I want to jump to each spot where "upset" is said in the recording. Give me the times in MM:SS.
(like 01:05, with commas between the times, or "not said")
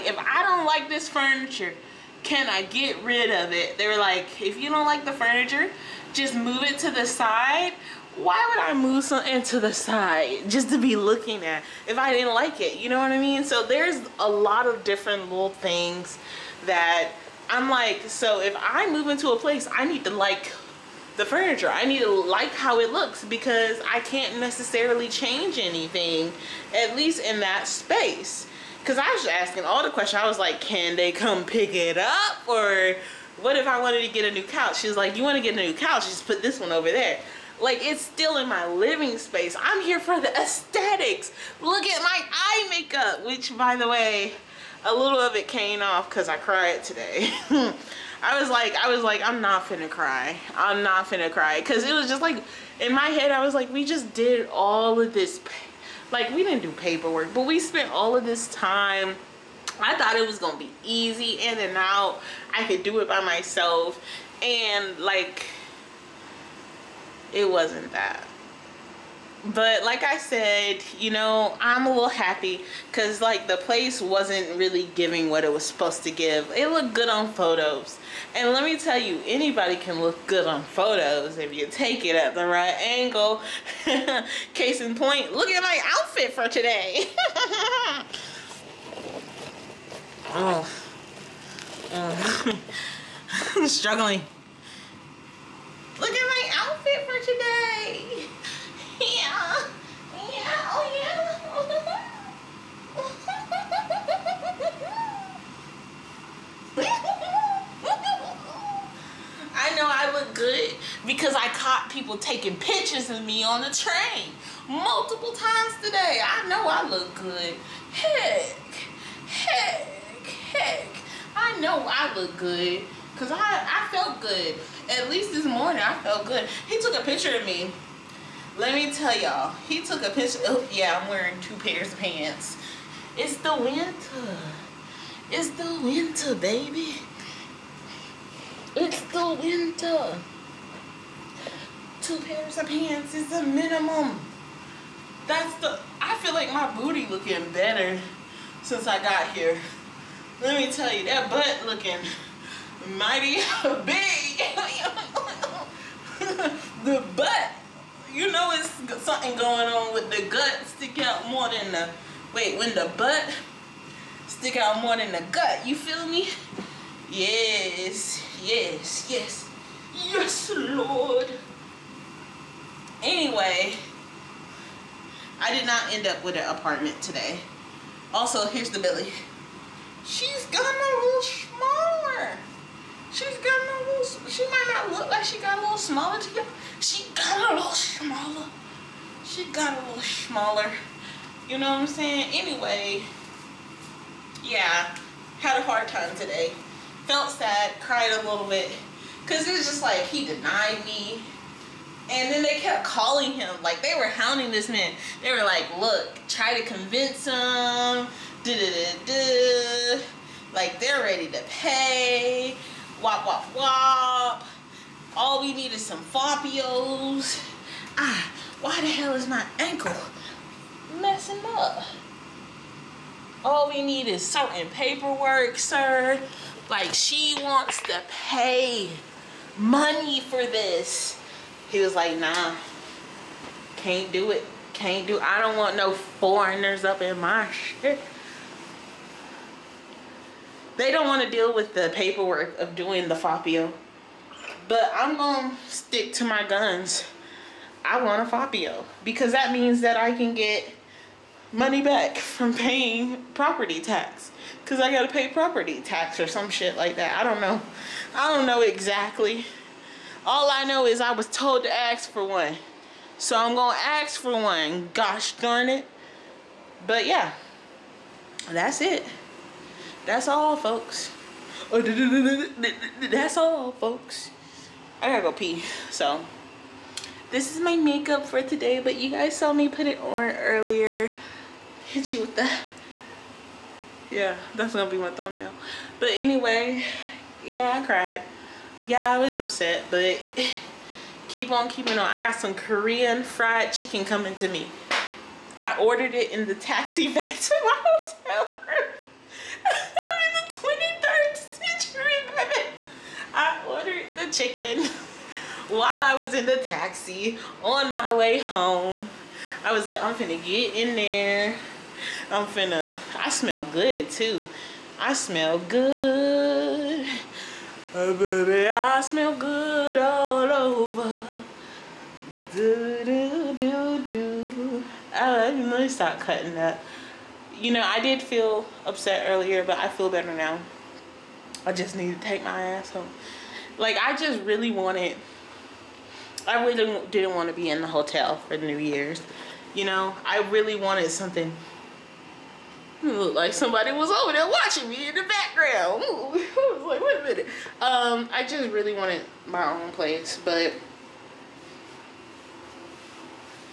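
04:49, 05:28.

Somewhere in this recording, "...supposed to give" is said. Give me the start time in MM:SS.
01:15.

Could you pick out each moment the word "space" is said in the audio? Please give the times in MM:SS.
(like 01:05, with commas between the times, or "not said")
00:27, 00:39.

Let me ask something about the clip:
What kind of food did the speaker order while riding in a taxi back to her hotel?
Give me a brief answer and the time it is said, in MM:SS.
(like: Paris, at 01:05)
Korean fried chicken, at 04:52.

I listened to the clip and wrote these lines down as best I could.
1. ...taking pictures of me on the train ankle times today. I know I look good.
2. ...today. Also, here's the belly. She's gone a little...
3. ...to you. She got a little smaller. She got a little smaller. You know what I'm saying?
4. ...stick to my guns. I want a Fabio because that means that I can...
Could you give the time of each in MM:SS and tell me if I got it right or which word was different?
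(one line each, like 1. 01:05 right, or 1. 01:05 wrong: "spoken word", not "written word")
1. 01:52 wrong: "multiple", not "ankle"
2. 02:57 right
3. 03:06 right
4. 04:05 right.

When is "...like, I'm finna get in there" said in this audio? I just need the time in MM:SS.
05:09.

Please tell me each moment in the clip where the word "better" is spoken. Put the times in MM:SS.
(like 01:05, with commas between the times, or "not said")
02:27, 05:30.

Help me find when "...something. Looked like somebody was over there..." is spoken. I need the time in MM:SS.
05:41.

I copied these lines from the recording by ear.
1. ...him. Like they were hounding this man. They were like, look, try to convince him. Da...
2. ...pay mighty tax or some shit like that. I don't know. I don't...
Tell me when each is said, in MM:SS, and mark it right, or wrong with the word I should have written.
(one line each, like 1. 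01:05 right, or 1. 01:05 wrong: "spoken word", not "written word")
1. 03:23 right
2. 04:15 wrong: "property", not "mighty".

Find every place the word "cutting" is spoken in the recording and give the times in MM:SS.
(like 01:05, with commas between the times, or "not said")
05:26.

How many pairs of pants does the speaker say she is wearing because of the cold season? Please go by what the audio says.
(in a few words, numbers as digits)
2.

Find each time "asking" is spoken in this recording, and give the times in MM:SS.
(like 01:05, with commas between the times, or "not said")
00:29.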